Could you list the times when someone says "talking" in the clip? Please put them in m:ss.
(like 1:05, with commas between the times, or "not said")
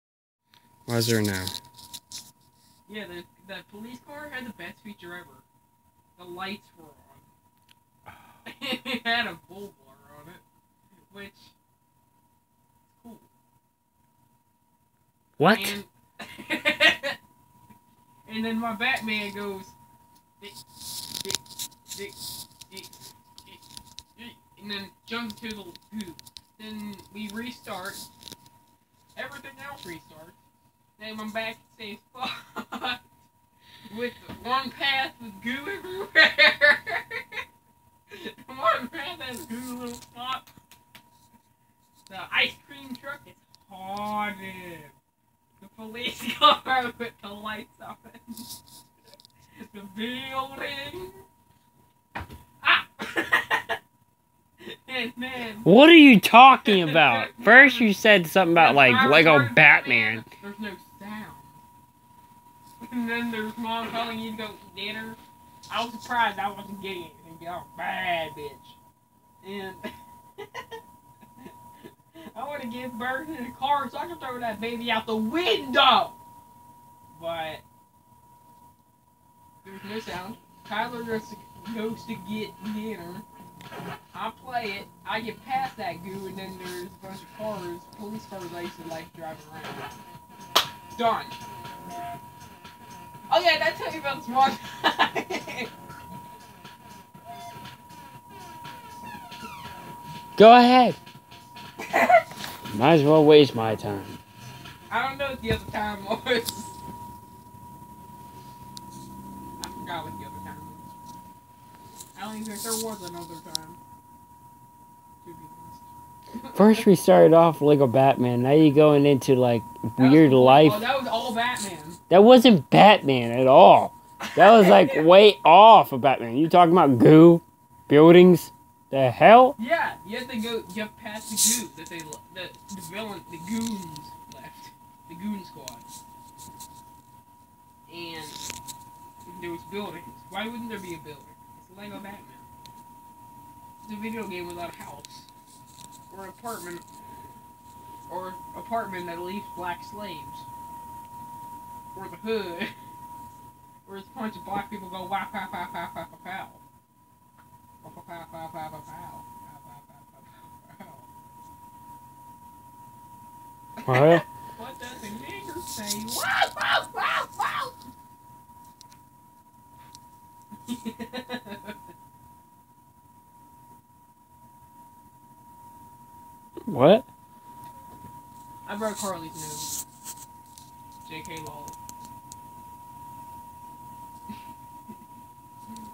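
0:56, 2:06.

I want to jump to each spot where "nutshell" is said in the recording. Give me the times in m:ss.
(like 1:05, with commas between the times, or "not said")
not said.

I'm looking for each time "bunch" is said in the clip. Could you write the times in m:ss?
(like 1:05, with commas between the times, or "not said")
1:27, 2:34.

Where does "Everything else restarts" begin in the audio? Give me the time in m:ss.
0:29.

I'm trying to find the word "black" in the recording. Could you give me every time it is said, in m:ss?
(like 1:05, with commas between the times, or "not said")
2:29, 2:34.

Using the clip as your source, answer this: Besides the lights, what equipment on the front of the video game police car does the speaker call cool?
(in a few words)
Bull bar.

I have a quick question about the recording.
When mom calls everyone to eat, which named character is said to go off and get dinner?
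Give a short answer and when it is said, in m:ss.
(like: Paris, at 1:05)
Tyler, at 1:20.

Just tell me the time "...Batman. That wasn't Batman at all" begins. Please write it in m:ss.
2:01.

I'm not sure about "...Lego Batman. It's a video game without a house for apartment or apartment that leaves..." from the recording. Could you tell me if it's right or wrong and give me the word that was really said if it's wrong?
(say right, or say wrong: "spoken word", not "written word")
right.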